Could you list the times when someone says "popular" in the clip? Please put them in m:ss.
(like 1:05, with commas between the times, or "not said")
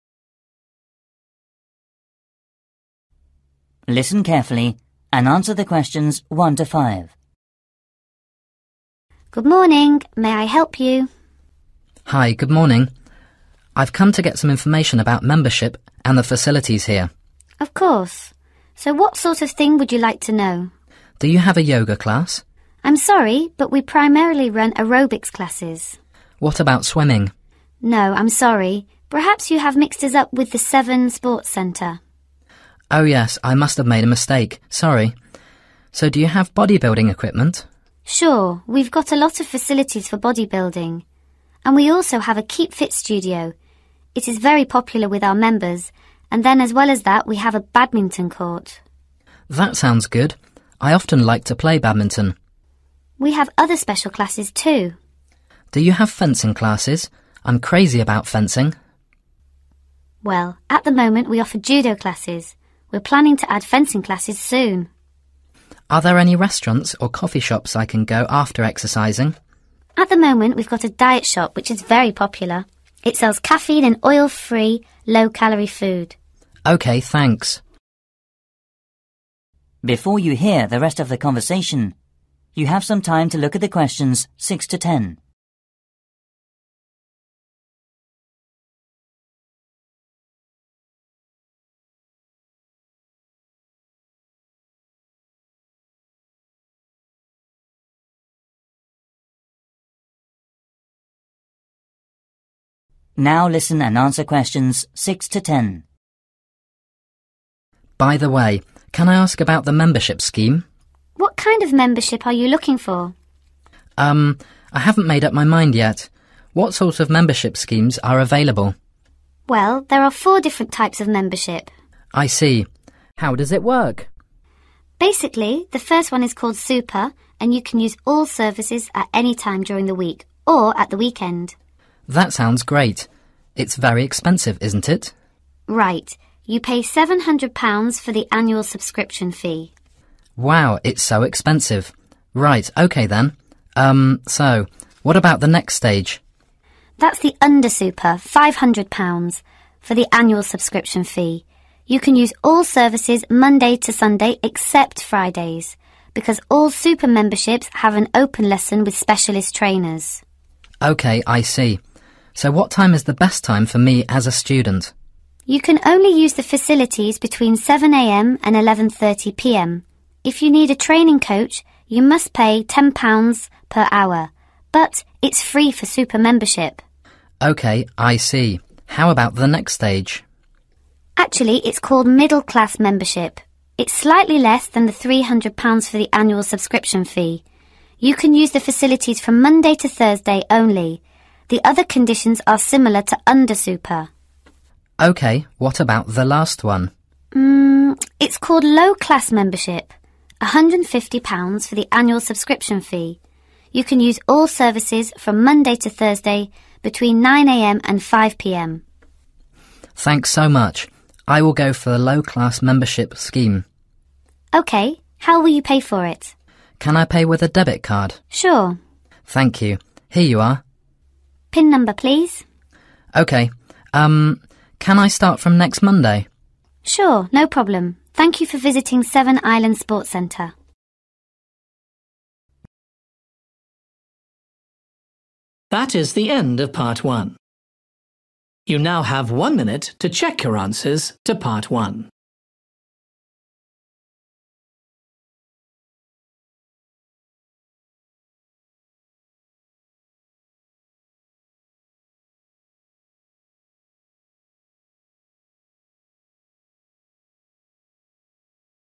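0:44, 1:12.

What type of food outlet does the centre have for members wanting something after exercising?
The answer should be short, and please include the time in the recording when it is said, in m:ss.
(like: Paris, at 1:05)
diet shop, at 1:10.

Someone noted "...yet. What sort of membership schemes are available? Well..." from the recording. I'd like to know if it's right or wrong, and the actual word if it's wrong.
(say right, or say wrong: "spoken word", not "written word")
right.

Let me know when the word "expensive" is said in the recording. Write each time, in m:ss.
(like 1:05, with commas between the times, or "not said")
2:14, 2:21.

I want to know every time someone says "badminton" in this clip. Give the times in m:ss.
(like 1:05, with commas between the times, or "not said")
0:47, 0:51.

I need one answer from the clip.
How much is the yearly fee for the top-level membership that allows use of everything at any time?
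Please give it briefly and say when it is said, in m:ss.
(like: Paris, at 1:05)
£700, at 2:16.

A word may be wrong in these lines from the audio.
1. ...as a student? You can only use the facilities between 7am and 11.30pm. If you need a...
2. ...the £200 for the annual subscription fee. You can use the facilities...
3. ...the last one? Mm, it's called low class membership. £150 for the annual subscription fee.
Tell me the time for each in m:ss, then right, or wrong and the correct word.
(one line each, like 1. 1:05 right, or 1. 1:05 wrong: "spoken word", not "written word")
1. 2:44 right
2. 3:04 wrong: "300", not "200"
3. 3:16 right.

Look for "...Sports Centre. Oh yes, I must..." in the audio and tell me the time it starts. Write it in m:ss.
0:31.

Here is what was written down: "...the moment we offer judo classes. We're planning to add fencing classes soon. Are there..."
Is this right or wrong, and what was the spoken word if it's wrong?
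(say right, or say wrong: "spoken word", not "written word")
right.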